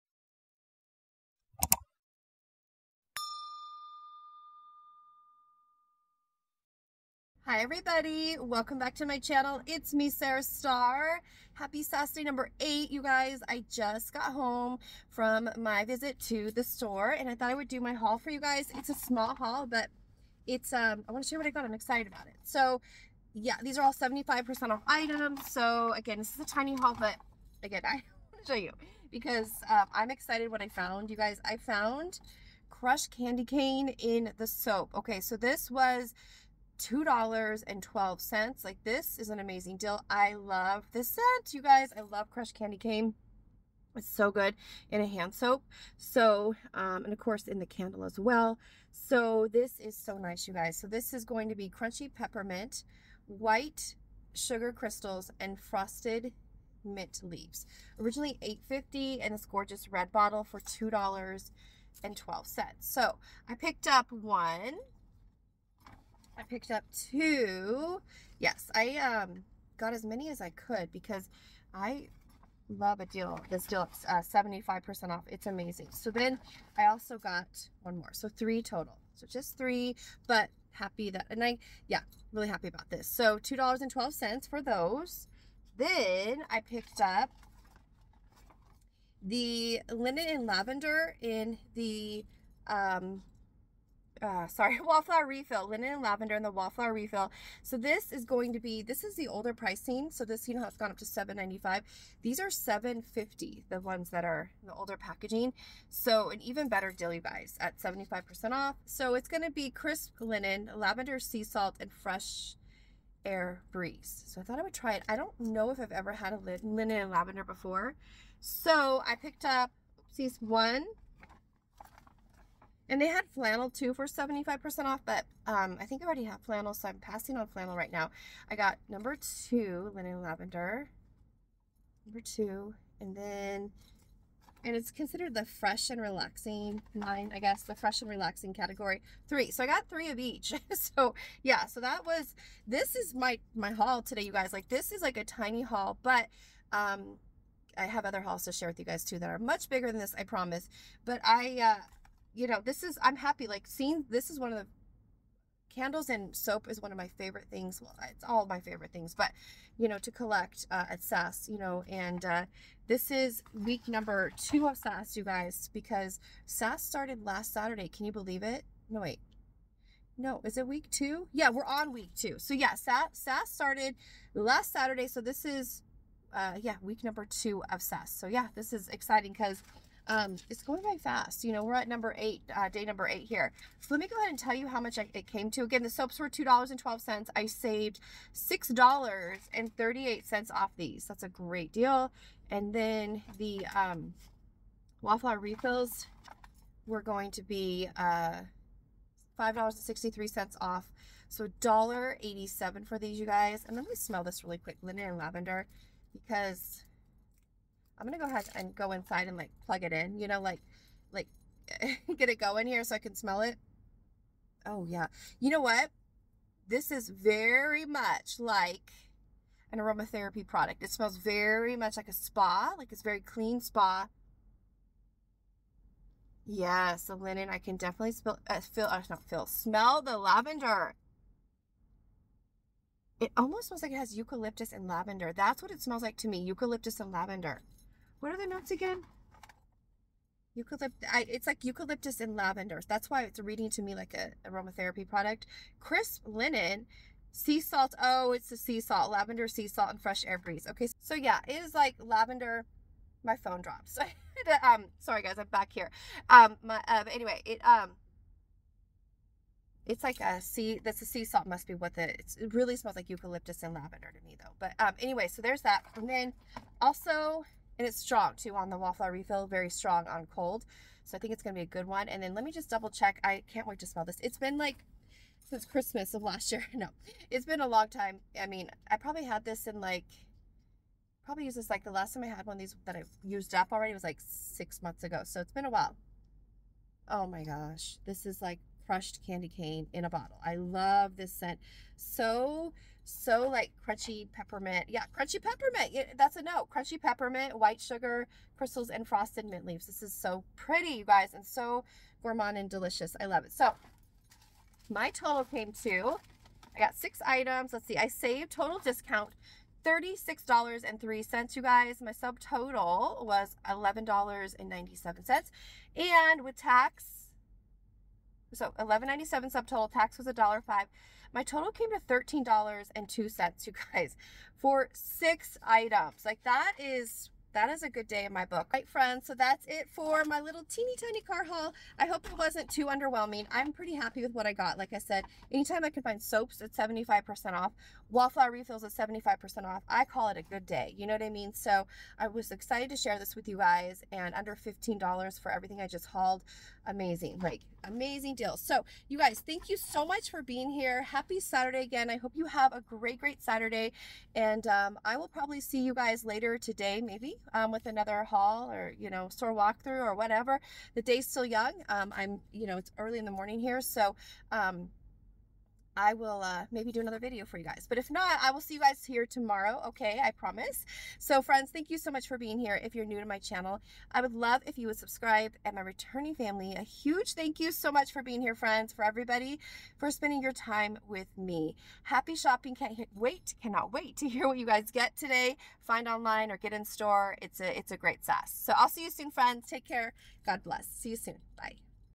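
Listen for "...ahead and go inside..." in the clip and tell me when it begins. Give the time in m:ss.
3:28.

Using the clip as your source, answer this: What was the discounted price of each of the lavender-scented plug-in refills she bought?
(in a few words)
$1.87.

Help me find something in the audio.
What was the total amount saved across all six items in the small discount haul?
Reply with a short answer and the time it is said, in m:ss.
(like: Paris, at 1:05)
$36.03, at 5:09.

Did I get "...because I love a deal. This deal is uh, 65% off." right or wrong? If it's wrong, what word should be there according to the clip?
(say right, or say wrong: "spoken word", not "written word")
wrong: "75", not "65".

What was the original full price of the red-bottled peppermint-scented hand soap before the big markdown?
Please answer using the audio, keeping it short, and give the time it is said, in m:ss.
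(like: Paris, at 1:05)
$8.50, at 0:58.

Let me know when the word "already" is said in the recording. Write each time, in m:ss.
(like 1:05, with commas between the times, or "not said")
2:06, 4:43.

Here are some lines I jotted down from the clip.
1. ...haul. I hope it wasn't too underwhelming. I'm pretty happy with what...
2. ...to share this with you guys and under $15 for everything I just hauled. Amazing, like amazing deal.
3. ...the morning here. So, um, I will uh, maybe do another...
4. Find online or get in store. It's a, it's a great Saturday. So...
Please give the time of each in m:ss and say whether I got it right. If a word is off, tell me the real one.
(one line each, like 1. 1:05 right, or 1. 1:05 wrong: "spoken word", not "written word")
1. 5:31 right
2. 5:42 right
3. 6:03 right
4. 6:25 wrong: "SAS", not "Saturday".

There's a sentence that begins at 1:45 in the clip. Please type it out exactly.
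So an even better Dilly buys at 75% off.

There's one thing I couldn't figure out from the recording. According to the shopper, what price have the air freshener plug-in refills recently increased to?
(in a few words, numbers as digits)
$7.95.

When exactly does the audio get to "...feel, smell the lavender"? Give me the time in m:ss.
3:49.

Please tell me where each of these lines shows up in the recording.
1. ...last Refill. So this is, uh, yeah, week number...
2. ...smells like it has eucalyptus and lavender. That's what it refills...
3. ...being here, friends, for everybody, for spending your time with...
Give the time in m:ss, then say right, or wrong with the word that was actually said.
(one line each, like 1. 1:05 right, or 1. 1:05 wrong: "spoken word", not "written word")
1. 2:54 wrong: "Saturday", not "Refill"
2. 3:53 wrong: "smells", not "refills"
3. 6:18 right.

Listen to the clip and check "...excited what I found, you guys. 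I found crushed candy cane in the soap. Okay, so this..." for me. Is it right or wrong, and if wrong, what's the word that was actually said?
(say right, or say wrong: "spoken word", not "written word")
right.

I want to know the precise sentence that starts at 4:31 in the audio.
So I think it's going to be a good one.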